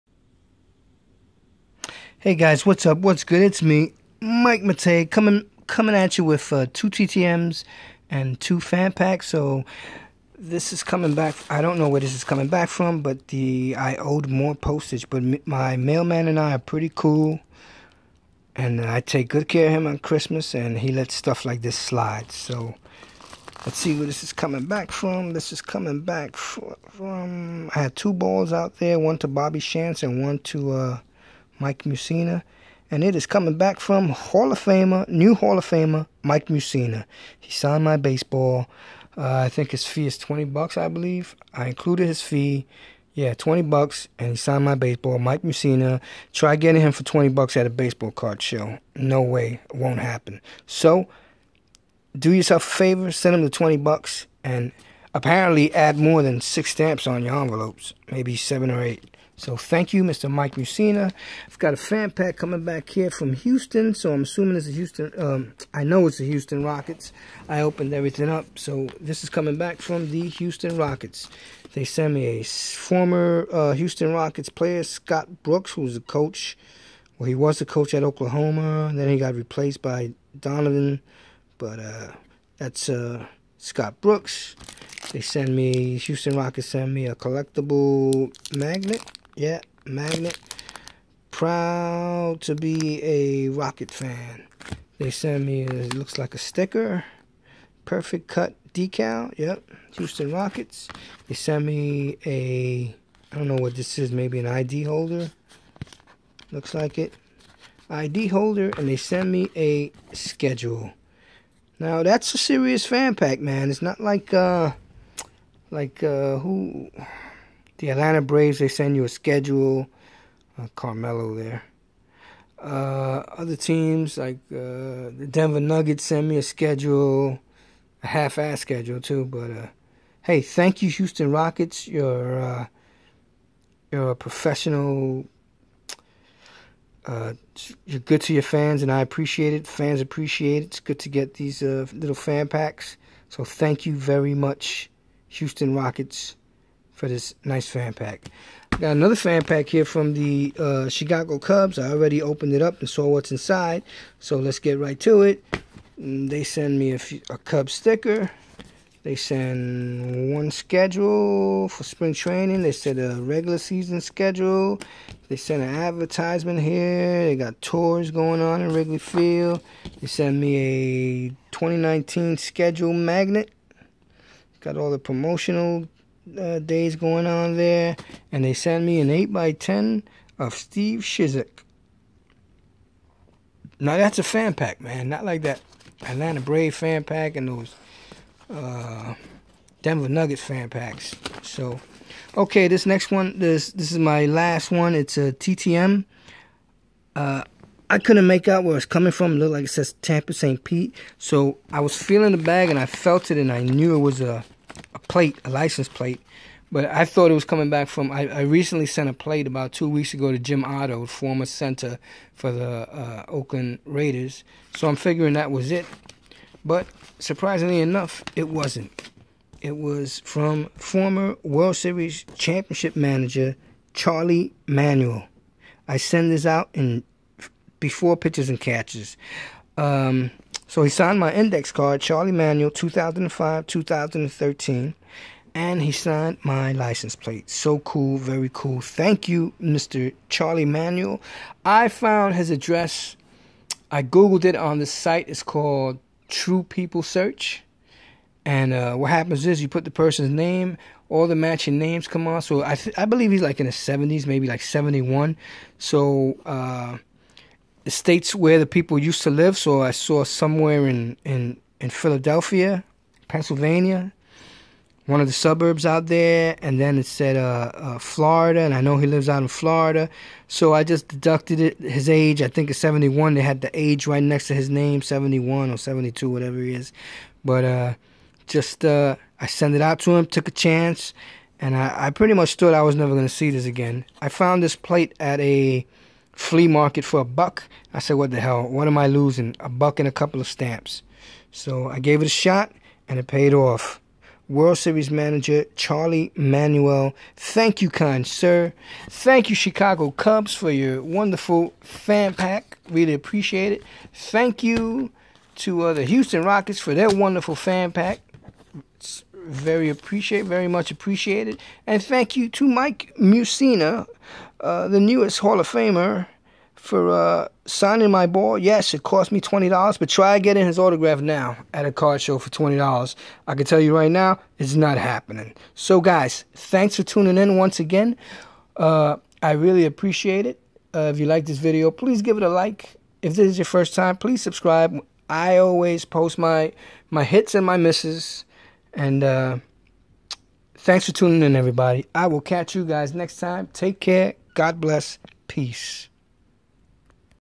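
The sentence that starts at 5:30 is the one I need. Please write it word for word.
Uh, if you like this video, please give it a like.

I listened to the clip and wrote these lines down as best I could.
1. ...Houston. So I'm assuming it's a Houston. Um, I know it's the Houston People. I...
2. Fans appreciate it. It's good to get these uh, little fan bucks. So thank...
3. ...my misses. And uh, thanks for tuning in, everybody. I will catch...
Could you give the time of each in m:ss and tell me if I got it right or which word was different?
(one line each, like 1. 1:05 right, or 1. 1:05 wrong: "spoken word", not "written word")
1. 1:03 wrong: "Rockets", not "People"
2. 2:19 wrong: "packs", not "bucks"
3. 5:37 right.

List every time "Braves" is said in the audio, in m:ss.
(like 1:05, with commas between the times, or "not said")
1:58, 3:06.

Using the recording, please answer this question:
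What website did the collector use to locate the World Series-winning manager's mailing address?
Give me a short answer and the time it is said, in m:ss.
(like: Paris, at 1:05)
True People Search, at 4:06.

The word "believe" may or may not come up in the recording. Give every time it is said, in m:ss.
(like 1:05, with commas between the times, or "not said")
0:40, 4:13.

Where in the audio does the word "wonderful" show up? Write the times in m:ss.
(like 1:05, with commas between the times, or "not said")
5:01, 5:07.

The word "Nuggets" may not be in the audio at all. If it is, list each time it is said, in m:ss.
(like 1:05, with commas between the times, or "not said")
2:05, 3:10.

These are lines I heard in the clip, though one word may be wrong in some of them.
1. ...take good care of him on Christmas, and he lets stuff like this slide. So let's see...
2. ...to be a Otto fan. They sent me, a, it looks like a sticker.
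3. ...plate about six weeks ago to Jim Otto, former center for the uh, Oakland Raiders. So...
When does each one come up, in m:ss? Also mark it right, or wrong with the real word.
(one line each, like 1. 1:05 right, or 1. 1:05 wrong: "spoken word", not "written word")
1. 0:19 right
2. 1:32 wrong: "Rocket", not "Otto"
3. 3:29 wrong: "two", not "six".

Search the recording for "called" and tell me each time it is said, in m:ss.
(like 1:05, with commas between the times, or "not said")
4:05.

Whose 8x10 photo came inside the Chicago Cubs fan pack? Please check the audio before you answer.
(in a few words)
Steve Cishek.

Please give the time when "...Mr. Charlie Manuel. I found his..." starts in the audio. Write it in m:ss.
3:59.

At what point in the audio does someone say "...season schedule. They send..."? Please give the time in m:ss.
2:43.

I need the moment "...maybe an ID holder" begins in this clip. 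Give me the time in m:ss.
1:44.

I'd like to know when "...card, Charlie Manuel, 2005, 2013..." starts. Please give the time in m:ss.
3:51.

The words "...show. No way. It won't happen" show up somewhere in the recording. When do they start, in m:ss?
0:48.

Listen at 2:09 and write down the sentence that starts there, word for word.
But uh, hey, thank you, Houston Rockets.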